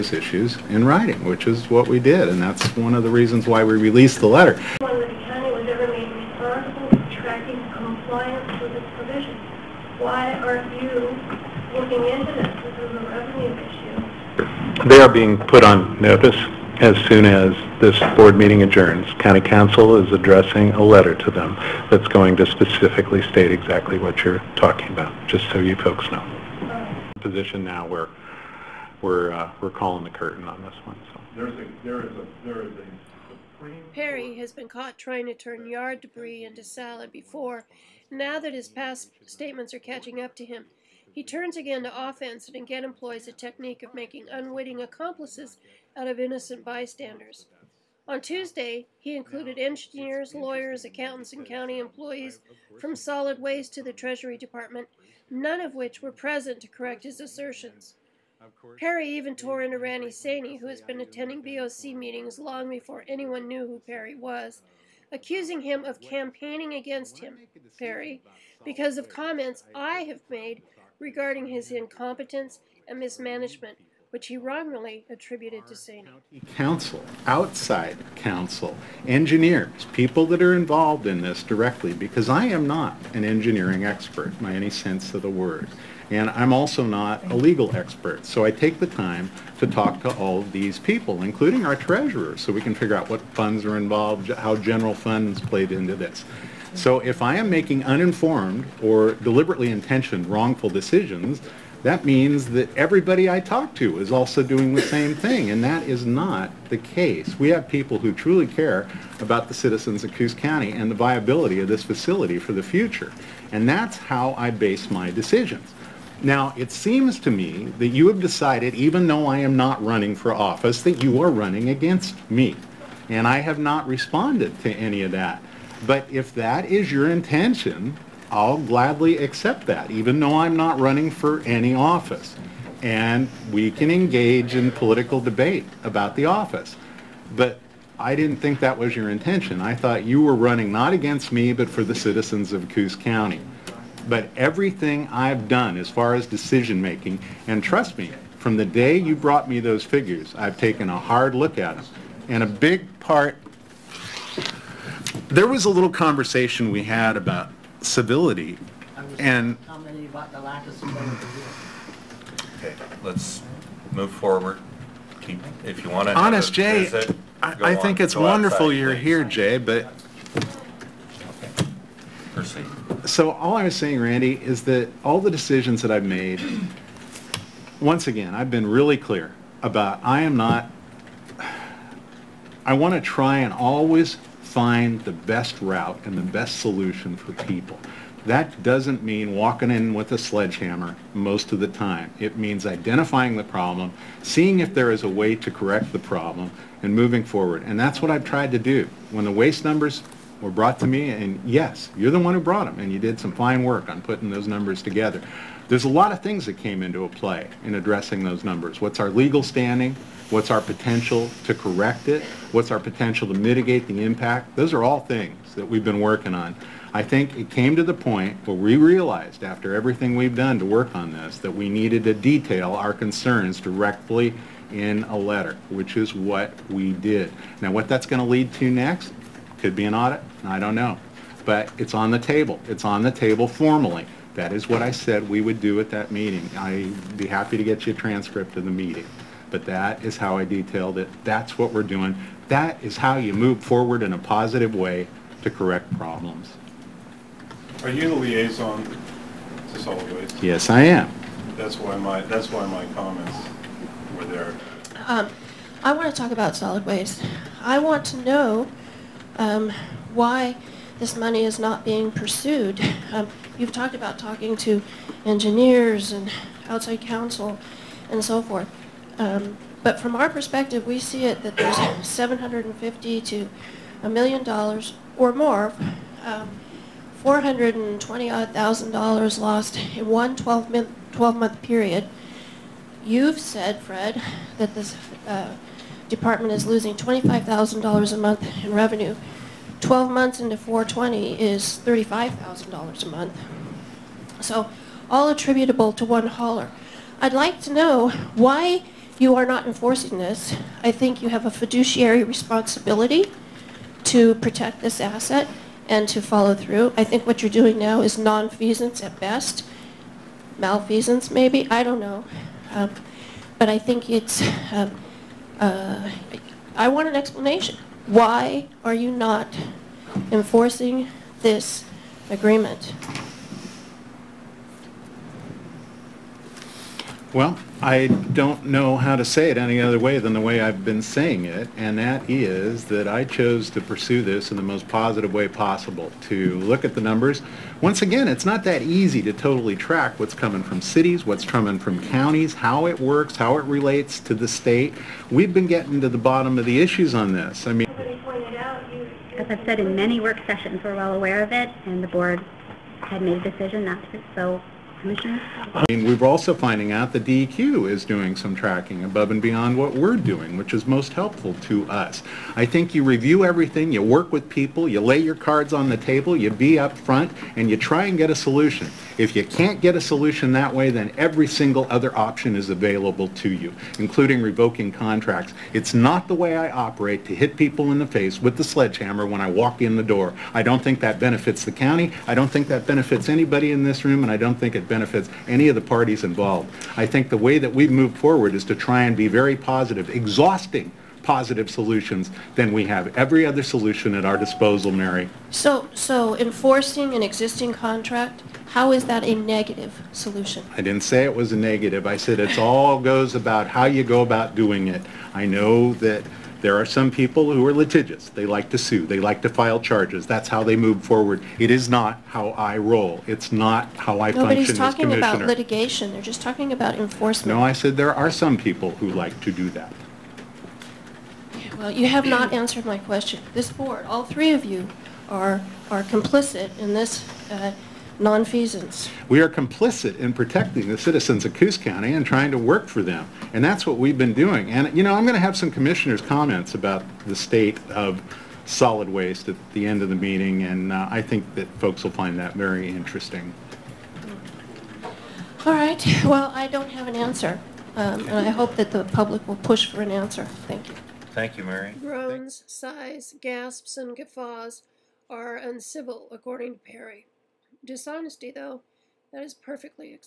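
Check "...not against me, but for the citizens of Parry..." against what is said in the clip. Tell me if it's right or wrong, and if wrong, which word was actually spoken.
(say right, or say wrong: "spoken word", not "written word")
wrong: "Coos", not "Parry".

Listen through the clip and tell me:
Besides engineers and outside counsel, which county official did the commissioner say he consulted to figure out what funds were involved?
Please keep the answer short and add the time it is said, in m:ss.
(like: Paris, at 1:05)
Our treasurer, at 1:31.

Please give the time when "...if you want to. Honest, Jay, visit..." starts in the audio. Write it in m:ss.
2:45.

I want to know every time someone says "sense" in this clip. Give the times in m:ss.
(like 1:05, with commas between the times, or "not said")
1:24.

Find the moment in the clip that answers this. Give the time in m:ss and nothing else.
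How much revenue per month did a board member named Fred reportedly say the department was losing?
4:46.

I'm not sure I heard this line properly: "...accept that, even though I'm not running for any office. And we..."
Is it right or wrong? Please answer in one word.
right.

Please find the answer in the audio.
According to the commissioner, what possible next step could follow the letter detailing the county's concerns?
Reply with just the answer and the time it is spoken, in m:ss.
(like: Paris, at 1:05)
An audit, at 3:49.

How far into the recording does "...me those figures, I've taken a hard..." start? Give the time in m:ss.
2:29.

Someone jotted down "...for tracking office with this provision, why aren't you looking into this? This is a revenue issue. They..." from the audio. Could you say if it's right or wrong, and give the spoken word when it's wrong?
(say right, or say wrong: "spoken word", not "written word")
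wrong: "compliance", not "office".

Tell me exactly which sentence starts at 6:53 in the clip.
It's not how I Nobody's function as commissioner.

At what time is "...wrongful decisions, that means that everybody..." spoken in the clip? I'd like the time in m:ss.
1:40.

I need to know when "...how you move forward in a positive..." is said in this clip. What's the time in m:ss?
4:02.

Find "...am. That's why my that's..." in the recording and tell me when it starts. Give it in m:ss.
4:10.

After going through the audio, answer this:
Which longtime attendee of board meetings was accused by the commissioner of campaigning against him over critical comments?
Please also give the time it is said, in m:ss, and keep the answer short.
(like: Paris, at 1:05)
Randy Sanne, at 0:59.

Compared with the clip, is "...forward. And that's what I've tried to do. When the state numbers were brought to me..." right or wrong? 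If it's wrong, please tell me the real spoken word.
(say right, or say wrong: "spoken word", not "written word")
wrong: "waste", not "state".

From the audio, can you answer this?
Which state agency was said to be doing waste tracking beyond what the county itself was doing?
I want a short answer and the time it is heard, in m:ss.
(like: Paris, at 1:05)
DEQ, at 5:57.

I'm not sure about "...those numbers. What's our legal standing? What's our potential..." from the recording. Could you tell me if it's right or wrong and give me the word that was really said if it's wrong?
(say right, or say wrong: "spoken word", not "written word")
right.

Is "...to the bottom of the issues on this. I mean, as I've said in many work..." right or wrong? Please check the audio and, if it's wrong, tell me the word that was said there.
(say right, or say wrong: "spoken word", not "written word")
right.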